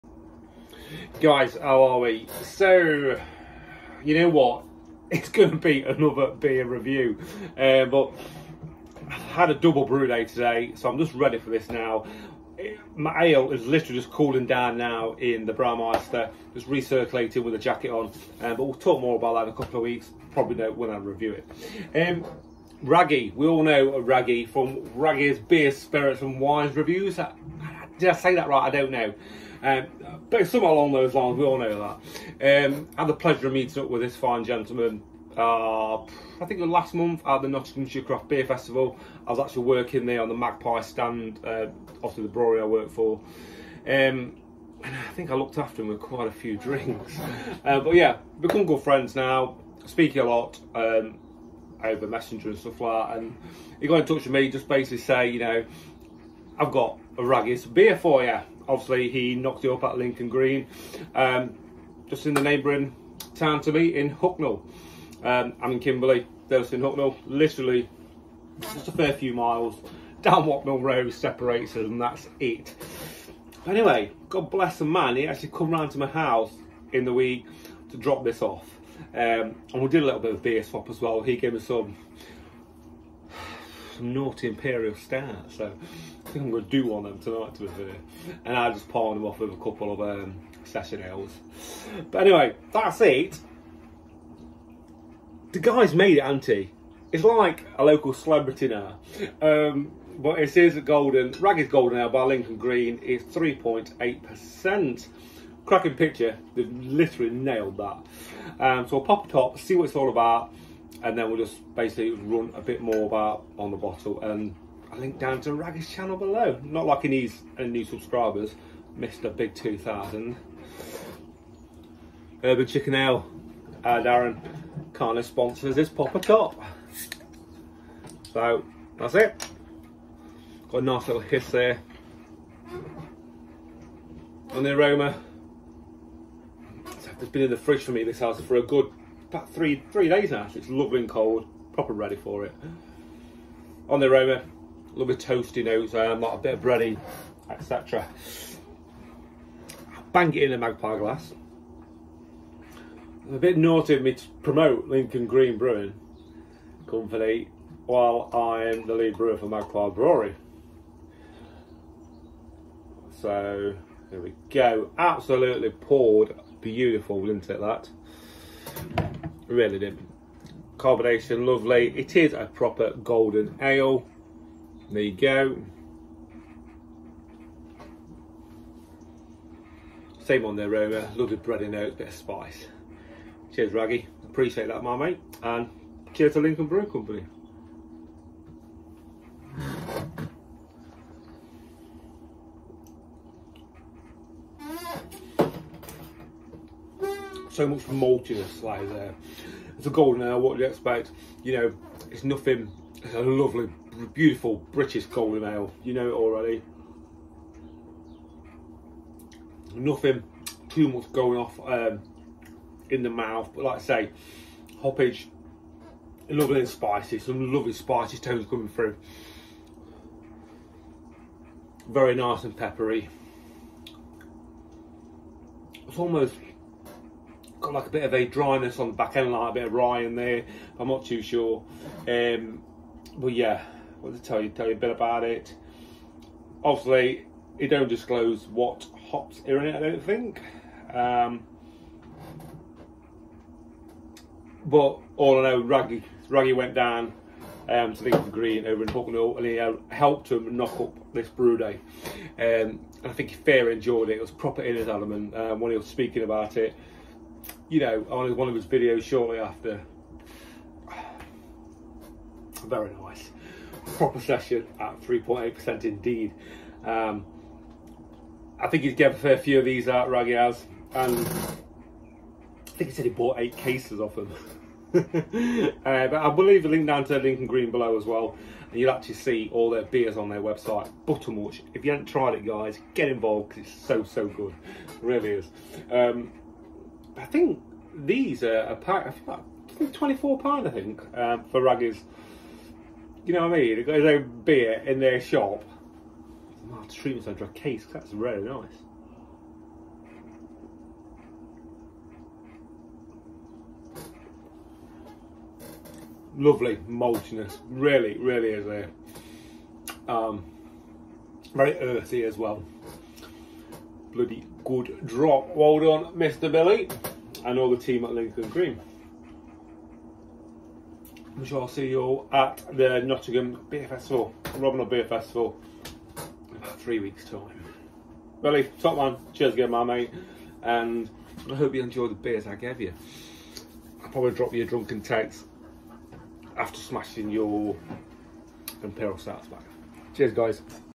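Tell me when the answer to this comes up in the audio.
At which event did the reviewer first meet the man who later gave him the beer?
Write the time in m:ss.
0:37.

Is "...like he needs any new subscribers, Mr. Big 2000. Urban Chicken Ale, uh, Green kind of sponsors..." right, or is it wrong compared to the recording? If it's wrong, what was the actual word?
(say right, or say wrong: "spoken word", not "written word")
wrong: "Darren", not "Green".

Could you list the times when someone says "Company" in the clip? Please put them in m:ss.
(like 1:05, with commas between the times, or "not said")
2:36, 3:06.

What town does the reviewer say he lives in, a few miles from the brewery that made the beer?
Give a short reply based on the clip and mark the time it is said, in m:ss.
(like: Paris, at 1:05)
Kimberley, at 1:05.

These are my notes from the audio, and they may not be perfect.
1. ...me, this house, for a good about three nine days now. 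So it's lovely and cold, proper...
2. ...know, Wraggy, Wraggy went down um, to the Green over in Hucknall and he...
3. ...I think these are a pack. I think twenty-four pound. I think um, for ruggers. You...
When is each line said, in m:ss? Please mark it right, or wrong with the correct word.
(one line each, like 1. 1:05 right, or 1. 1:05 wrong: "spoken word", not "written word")
1. 2:17 wrong: "three", not "nine"
2. 4:05 right
3. 4:47 right.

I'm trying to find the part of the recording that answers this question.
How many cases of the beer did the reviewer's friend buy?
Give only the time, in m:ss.
4:33.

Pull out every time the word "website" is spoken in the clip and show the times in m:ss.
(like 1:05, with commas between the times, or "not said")
4:40.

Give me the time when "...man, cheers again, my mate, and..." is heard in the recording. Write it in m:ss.
5:28.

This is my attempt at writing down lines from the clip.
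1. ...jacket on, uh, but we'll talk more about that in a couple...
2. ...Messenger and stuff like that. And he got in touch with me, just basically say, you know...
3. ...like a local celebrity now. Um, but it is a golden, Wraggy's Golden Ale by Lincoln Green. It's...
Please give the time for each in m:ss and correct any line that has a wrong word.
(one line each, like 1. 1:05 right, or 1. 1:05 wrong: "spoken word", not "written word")
1. 0:17 right
2. 0:52 right
3. 1:37 right.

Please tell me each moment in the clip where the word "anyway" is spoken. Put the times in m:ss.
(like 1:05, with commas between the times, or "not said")
1:13, 1:32.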